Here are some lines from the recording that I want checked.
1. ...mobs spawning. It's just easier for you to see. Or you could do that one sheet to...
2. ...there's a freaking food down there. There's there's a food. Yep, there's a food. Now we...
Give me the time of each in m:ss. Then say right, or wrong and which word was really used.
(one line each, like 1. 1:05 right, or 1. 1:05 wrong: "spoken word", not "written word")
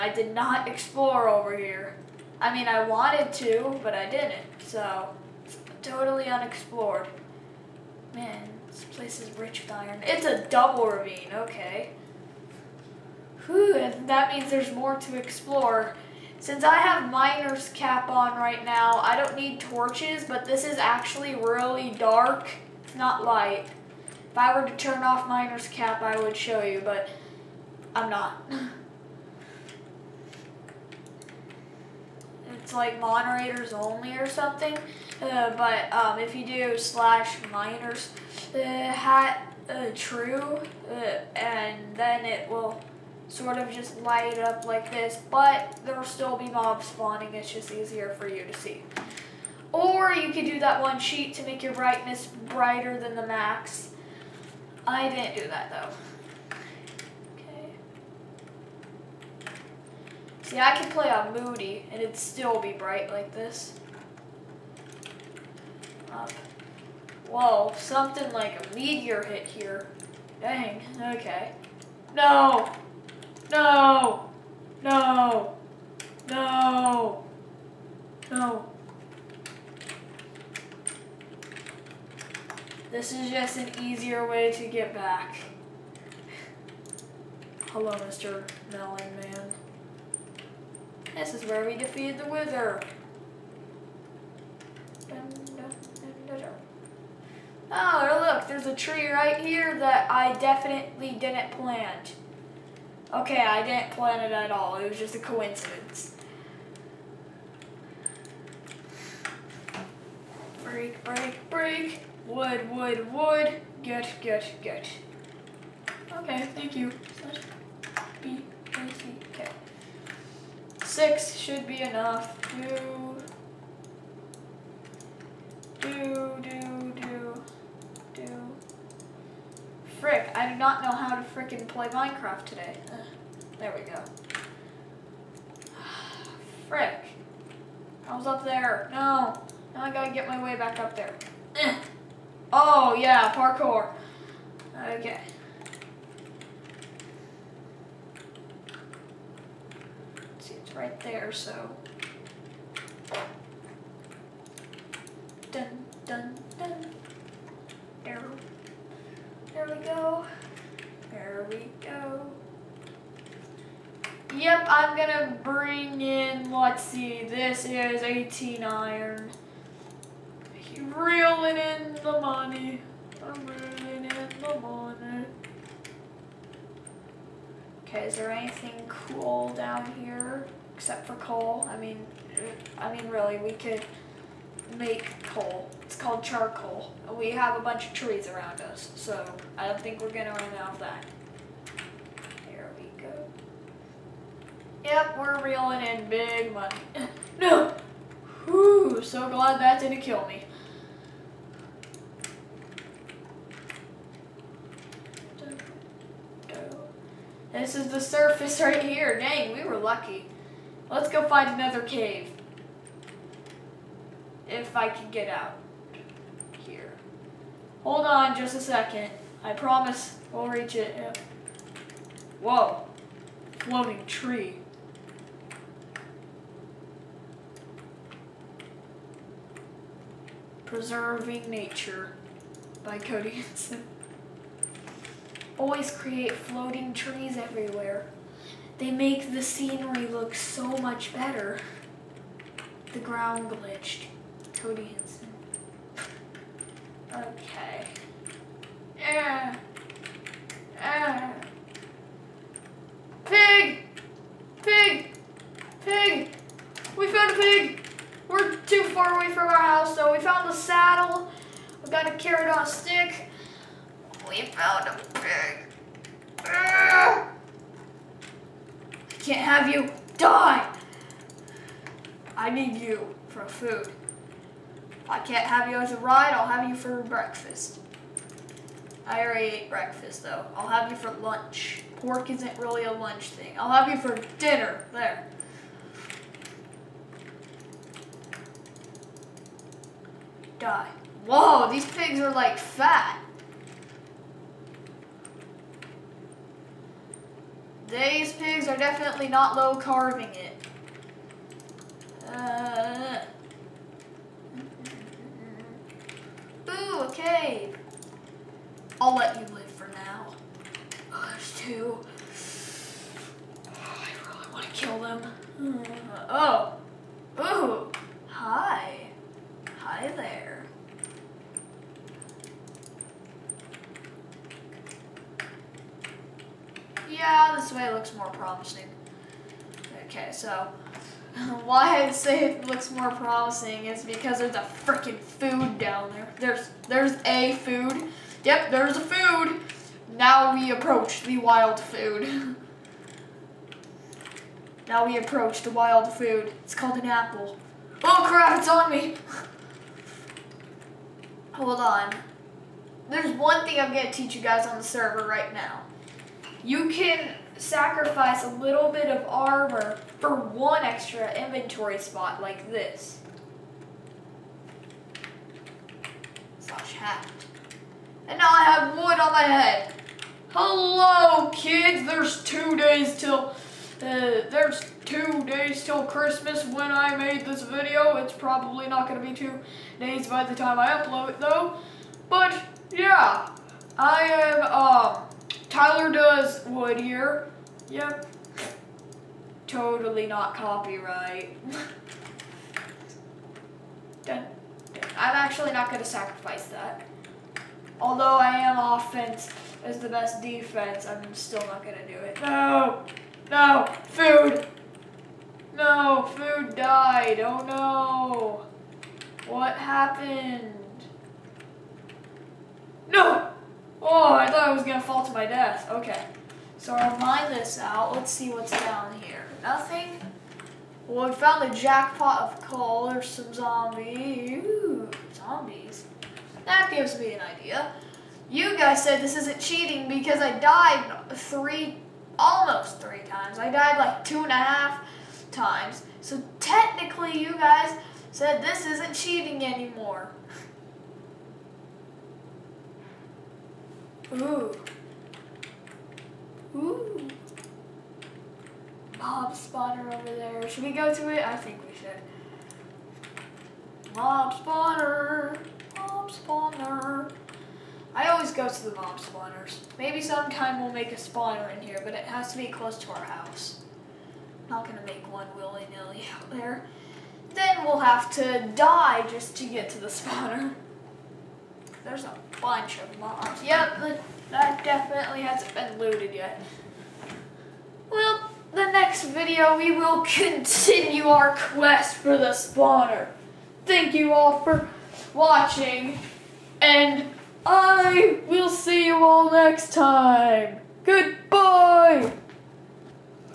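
1. 0:46 right
2. 5:34 right.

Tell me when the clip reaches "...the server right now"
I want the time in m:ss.
5:54.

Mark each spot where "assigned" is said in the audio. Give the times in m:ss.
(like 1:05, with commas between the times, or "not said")
not said.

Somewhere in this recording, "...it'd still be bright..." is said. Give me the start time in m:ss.
1:02.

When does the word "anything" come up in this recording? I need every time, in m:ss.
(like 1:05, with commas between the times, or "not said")
2:58.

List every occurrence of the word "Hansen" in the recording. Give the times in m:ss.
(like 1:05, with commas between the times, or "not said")
3:53, 4:04.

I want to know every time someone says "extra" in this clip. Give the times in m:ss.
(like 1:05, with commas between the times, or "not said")
6:00.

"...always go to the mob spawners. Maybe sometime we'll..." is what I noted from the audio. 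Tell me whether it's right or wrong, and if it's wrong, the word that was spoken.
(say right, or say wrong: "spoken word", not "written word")
right.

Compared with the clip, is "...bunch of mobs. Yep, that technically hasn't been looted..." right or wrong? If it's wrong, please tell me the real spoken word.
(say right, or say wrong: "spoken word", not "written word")
wrong: "definitely", not "technically".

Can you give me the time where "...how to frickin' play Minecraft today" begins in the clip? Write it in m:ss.
2:10.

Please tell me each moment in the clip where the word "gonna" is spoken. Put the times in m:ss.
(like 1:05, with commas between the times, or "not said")
2:44, 3:10, 7:44.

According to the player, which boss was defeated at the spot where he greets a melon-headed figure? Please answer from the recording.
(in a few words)
the Wither.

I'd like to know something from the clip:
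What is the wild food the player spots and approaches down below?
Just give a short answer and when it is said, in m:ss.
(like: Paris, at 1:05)
an apple, at 5:47.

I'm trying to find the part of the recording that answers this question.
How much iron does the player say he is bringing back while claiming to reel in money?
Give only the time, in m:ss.
2:48.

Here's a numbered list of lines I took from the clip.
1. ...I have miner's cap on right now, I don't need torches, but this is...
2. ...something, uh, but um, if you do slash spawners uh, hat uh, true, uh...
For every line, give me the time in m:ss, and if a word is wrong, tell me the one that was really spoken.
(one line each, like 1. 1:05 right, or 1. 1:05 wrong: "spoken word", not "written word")
1. 0:16 right
2. 0:34 wrong: "miners", not "spawners".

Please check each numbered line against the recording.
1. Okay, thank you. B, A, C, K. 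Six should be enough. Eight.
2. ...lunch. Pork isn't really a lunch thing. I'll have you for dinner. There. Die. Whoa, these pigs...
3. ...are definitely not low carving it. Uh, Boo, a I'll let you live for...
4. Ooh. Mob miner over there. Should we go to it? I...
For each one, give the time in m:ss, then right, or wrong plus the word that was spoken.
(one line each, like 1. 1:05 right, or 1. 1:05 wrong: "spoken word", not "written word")
1. 1:56 wrong: "Two", not "Eight"
2. 4:41 right
3. 4:58 right
4. 7:26 wrong: "spawner", not "miner".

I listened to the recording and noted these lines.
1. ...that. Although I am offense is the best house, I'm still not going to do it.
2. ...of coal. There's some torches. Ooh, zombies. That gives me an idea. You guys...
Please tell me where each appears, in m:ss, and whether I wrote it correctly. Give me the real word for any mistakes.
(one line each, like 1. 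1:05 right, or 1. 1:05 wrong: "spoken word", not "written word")
1. 6:36 wrong: "defense", not "house"
2. 7:02 wrong: "zombies", not "torches".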